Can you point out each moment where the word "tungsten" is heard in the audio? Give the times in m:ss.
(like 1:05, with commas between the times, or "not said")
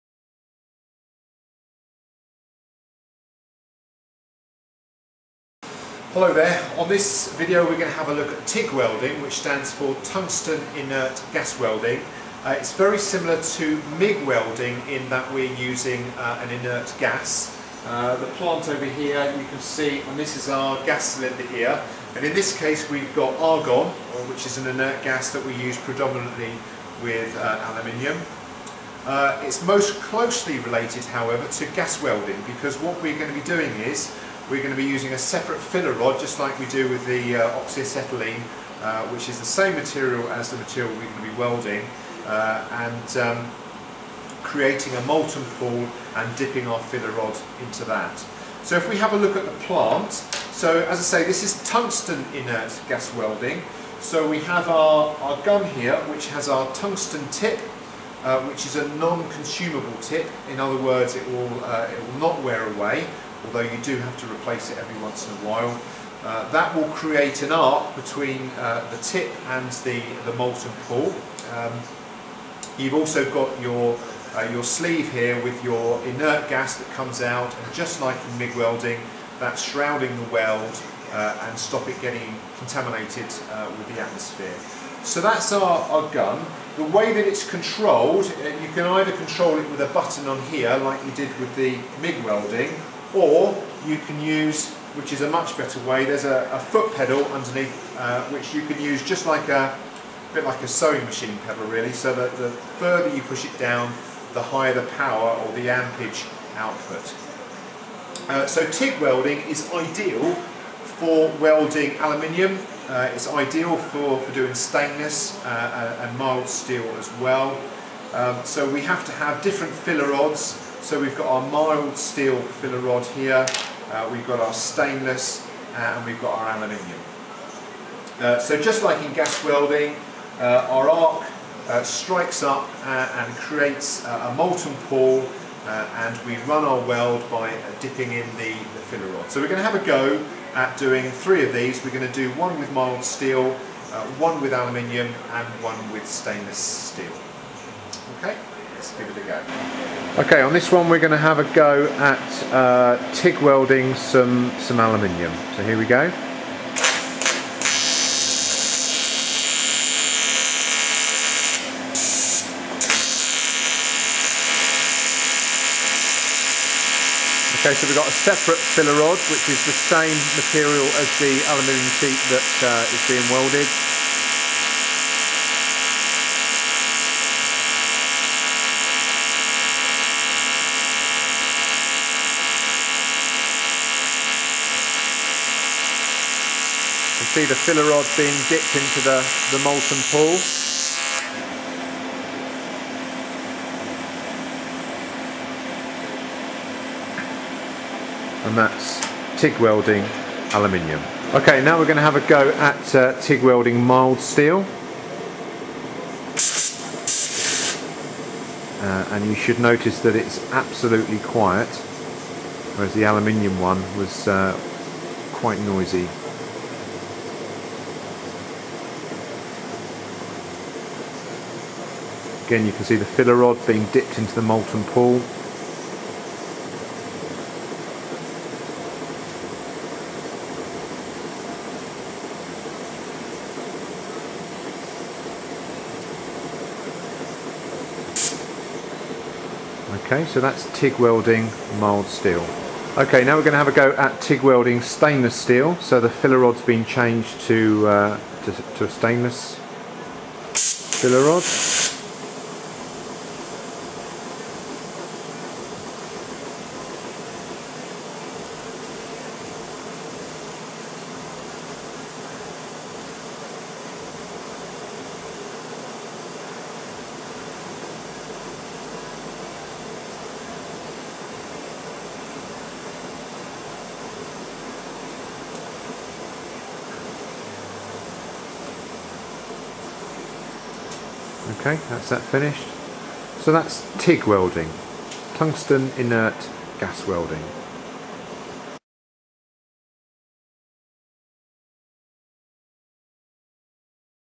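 0:10, 0:51, 0:56, 4:45.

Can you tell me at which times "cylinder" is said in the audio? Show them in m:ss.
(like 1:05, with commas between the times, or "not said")
0:21.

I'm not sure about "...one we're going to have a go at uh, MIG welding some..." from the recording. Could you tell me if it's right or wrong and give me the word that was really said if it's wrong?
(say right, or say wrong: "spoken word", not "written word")
wrong: "TIG", not "MIG".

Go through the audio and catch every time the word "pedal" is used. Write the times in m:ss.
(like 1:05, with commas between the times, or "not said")
1:36, 1:41.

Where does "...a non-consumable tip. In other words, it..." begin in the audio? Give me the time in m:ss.
0:58.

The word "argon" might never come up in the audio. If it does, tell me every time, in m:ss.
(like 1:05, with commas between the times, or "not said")
0:23.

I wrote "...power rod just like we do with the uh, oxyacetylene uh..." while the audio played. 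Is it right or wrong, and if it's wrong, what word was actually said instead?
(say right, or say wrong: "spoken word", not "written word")
wrong: "filler", not "power".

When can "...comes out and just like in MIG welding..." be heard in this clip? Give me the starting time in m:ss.
1:16.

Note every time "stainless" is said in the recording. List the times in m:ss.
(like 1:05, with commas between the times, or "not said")
1:54, 2:04, 2:26, 4:04, 4:08.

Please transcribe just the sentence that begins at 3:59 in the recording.
Okay, so that's TIG welding mild steel.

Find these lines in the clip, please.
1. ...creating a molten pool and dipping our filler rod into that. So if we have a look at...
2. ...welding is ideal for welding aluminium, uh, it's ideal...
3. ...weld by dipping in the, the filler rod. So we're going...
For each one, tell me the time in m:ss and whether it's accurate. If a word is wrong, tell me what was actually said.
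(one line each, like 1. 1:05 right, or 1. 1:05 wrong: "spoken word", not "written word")
1. 0:44 right
2. 1:49 right
3. 2:16 right.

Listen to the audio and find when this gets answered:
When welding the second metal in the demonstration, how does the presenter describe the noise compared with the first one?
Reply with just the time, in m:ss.
3:30.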